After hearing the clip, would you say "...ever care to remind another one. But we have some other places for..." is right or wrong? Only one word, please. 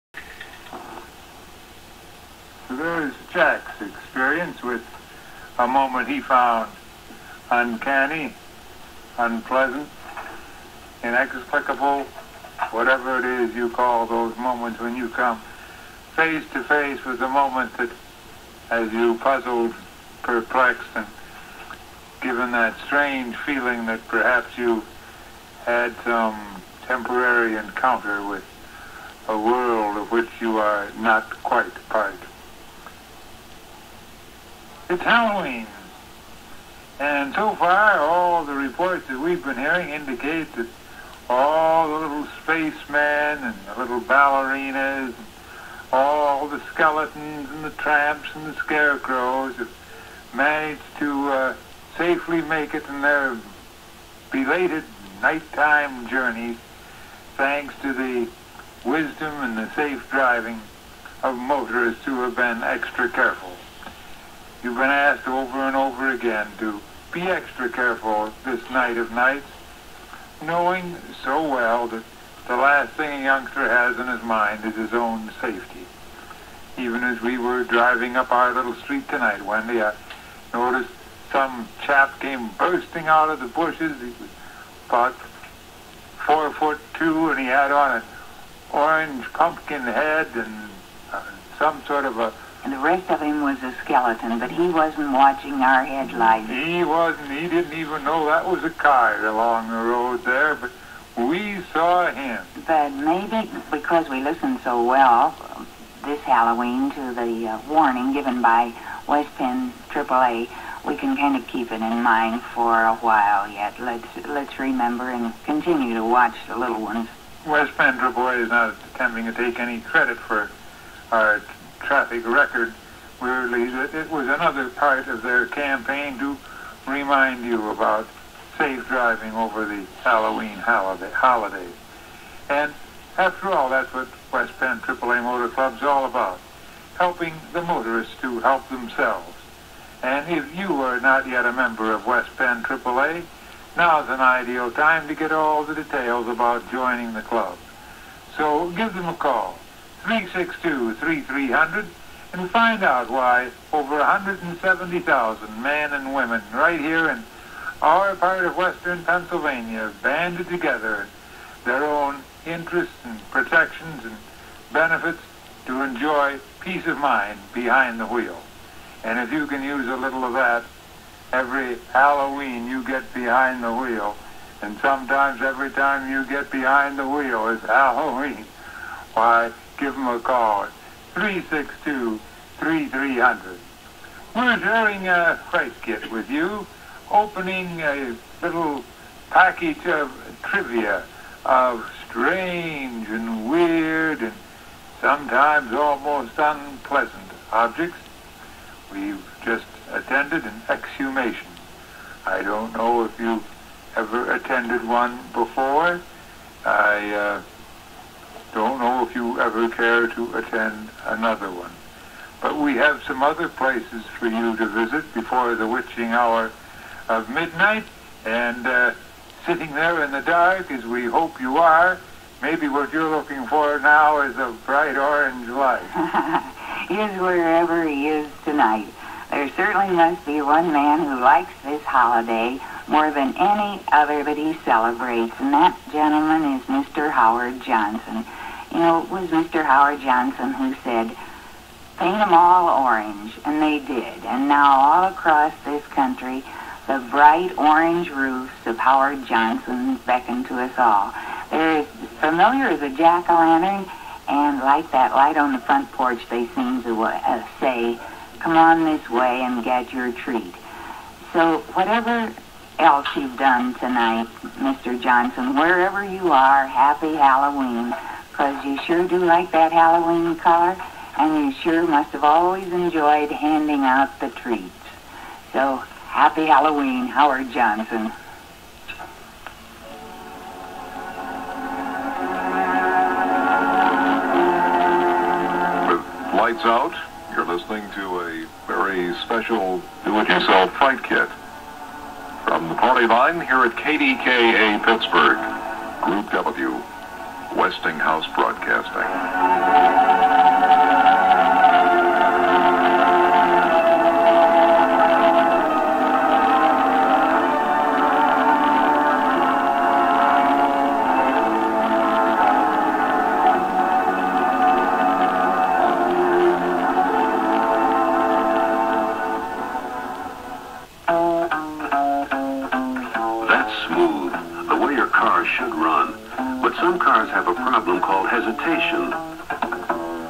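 wrong.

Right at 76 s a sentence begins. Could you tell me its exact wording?
Even as we were driving up our little street tonight, Wendy, I noticed some chap came bursting out of the bushes.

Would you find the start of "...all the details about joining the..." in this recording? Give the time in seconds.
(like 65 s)
145 s.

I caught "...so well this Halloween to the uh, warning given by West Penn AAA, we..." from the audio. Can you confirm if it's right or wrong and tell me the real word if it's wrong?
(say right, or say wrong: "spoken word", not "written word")
right.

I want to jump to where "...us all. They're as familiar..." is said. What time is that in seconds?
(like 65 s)
250 s.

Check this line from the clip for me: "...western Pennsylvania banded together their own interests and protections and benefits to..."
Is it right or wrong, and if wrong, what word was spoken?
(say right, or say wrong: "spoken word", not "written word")
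right.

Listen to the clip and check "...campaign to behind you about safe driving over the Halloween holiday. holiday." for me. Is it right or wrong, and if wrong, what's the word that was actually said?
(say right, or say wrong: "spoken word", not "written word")
wrong: "remind", not "behind".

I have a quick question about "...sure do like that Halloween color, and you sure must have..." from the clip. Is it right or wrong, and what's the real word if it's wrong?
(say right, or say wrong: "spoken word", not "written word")
right.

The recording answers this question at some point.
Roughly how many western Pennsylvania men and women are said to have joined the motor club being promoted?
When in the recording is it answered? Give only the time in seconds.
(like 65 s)
153 s.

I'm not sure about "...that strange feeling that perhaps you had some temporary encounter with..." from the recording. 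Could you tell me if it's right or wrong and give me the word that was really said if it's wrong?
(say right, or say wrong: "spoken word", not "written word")
right.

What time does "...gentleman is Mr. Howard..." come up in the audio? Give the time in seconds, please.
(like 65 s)
235 s.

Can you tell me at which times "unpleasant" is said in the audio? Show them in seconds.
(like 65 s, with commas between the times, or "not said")
9 s, 196 s.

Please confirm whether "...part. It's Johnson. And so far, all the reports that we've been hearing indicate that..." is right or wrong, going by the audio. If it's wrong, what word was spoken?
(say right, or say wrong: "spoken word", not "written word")
wrong: "Halloween", not "Johnson".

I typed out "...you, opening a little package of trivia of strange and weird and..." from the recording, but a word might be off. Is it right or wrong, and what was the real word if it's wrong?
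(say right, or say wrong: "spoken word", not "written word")
right.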